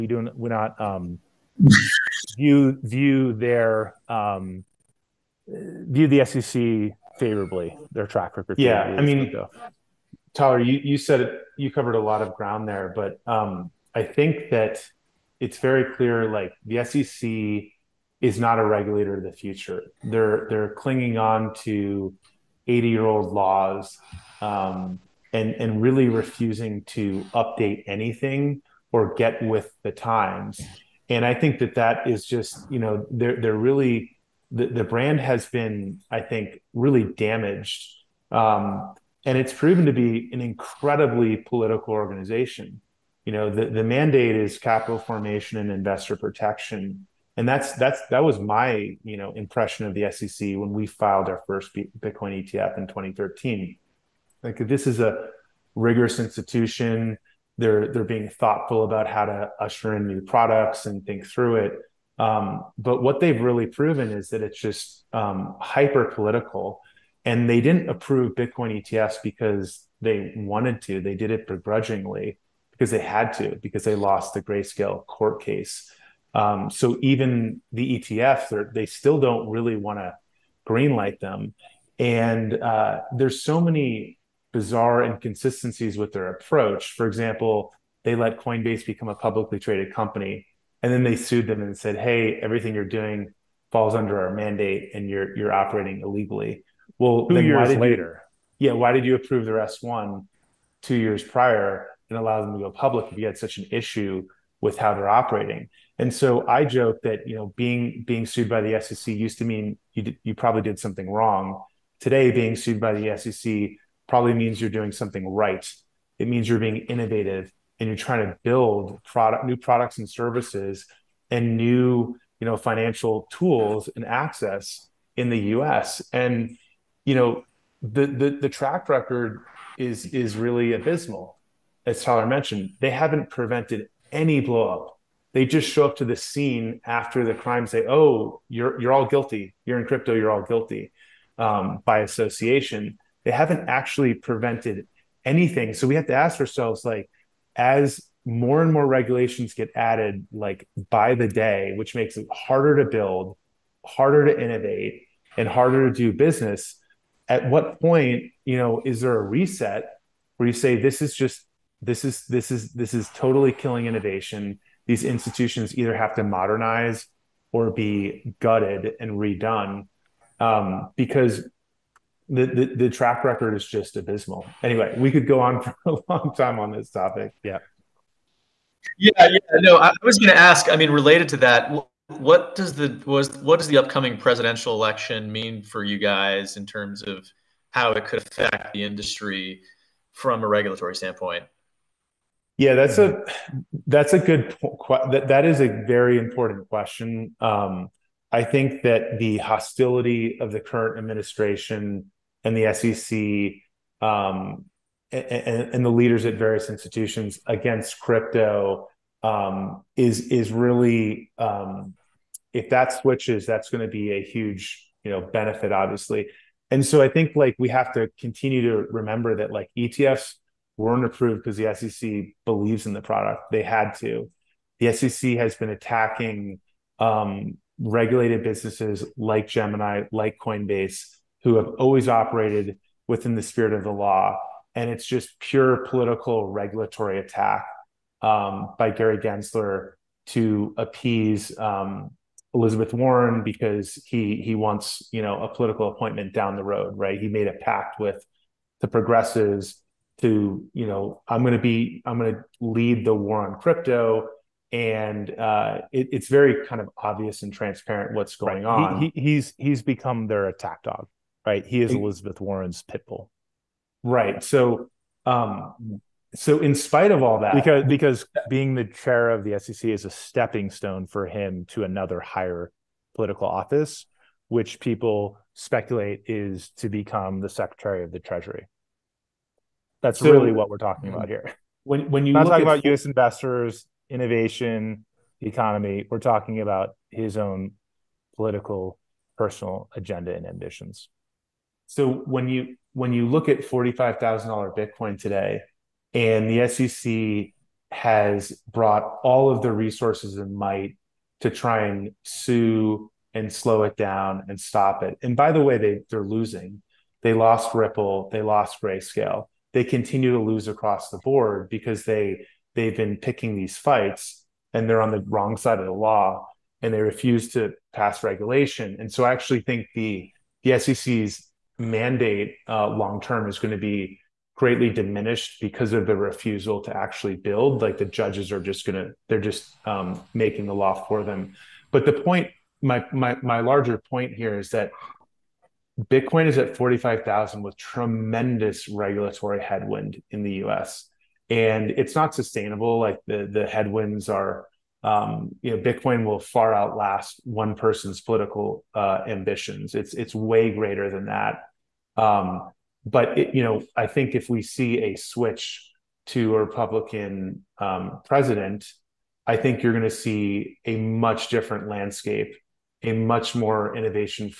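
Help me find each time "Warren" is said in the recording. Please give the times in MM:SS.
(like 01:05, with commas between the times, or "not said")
04:02, 04:22.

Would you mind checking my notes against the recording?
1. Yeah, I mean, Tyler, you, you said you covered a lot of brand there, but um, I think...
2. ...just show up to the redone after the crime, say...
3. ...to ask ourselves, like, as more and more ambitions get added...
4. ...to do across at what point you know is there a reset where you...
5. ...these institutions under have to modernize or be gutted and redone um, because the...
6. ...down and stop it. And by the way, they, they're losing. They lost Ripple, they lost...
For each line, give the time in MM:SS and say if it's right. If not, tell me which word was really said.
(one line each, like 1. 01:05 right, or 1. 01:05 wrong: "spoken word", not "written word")
1. 00:08 wrong: "ground", not "brand"
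2. 02:15 wrong: "scene", not "redone"
3. 02:26 wrong: "regulations", not "ambitions"
4. 02:35 wrong: "business", not "across"
5. 02:44 wrong: "either", not "under"
6. 05:03 right.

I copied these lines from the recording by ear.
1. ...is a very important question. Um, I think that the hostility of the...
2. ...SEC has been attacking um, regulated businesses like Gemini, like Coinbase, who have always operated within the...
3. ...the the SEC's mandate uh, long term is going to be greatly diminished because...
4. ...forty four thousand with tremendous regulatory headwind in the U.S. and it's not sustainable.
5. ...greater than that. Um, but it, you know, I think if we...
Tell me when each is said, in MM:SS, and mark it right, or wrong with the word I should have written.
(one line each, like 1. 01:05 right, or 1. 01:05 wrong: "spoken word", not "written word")
1. 03:15 right
2. 03:44 right
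3. 05:19 right
4. 05:36 wrong: "five", not "four"
5. 05:50 right.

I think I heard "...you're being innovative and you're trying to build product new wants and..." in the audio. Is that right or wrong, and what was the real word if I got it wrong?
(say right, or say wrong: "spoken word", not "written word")
wrong: "products", not "wants".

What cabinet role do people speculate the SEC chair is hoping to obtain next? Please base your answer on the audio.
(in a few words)
Secretary of the Treasury.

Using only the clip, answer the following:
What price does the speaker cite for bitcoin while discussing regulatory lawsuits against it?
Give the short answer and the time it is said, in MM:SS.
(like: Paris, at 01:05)
$45,000, at 04:53.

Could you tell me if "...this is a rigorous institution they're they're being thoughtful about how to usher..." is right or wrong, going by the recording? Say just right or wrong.
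right.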